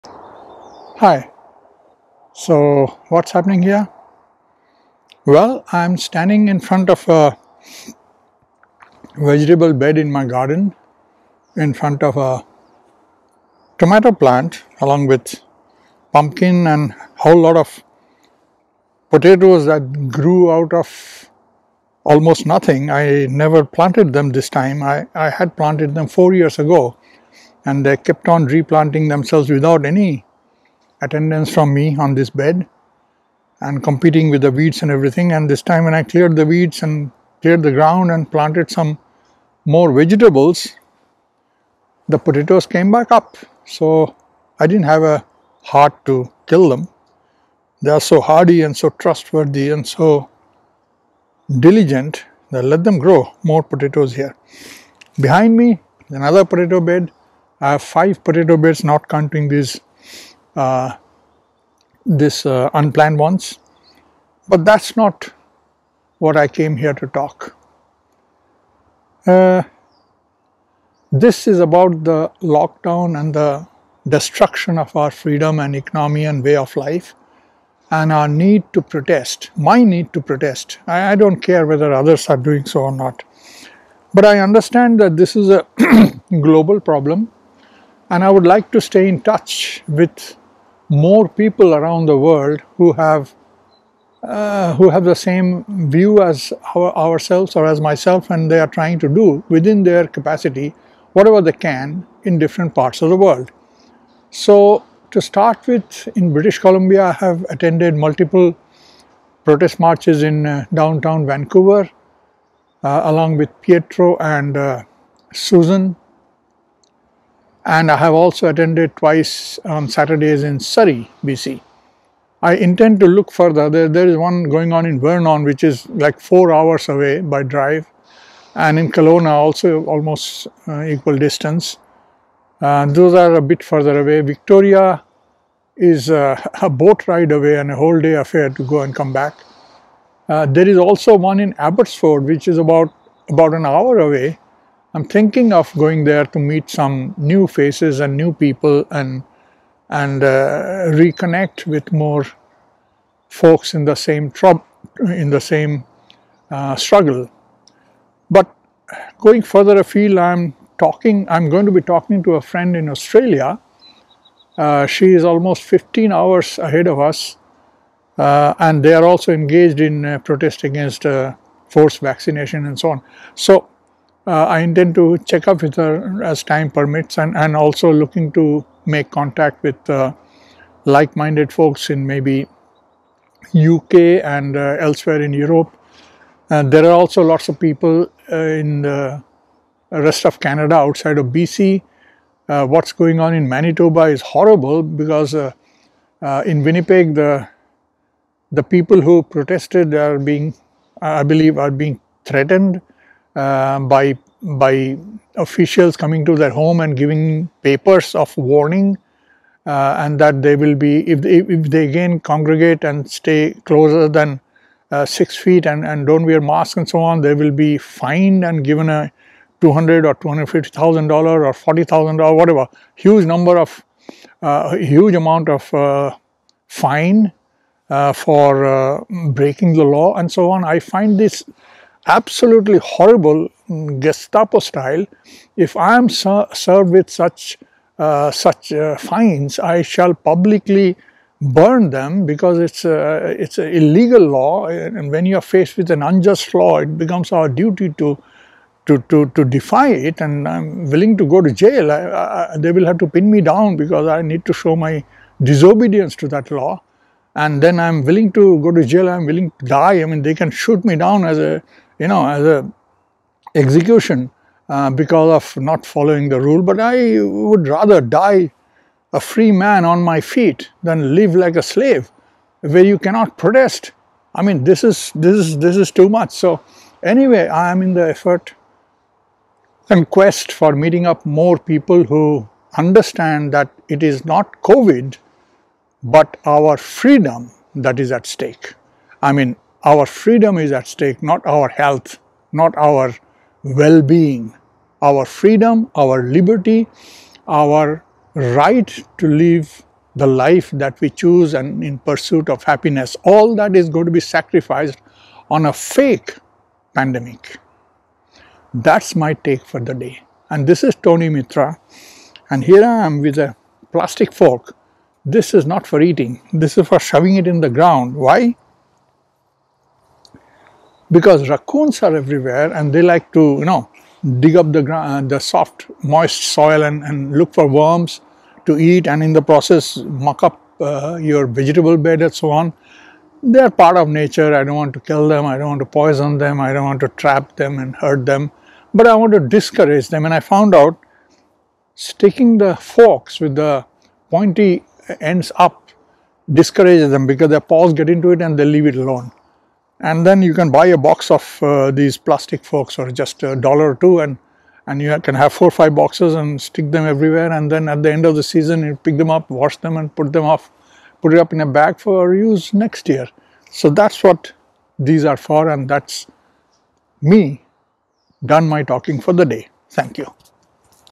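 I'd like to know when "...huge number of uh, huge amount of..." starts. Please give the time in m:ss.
3:42.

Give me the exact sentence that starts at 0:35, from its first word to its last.
And this time when I cleared the weeds and cleared the ground and planted some more vegetables, the potatoes came back up.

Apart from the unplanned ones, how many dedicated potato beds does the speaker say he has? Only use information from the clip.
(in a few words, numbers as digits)
5.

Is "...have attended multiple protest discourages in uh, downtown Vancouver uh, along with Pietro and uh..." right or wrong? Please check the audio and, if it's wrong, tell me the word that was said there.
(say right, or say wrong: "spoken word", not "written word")
wrong: "marches", not "discourages".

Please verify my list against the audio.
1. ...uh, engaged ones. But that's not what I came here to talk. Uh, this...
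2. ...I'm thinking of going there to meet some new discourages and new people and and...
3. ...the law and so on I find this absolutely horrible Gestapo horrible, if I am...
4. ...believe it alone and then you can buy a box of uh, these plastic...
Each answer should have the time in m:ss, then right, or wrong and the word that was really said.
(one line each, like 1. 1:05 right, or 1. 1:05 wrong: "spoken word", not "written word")
1. 1:02 wrong: "unplanned", not "engaged"
2. 2:24 wrong: "faces", not "discourages"
3. 3:49 wrong: "style", not "horrible"
4. 5:48 wrong: "leave", not "believe".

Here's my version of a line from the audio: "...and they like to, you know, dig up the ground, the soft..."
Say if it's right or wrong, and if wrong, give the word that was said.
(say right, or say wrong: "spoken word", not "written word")
right.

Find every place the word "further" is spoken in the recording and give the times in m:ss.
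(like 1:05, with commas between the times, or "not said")
2:03, 2:13, 2:39.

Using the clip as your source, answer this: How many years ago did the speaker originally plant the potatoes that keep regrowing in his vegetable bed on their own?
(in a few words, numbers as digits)
4.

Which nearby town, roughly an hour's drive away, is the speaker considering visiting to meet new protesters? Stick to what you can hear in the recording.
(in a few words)
Abbotsford.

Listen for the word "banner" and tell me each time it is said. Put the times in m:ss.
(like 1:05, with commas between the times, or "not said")
not said.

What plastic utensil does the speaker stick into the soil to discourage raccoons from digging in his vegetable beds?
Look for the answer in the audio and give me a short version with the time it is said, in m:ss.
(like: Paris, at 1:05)
plastic fork, at 5:13.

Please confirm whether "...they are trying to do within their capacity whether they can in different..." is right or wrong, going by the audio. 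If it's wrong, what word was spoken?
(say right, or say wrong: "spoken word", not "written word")
wrong: "whatever", not "whether".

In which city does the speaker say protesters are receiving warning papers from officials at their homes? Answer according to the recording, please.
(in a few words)
Winnipeg.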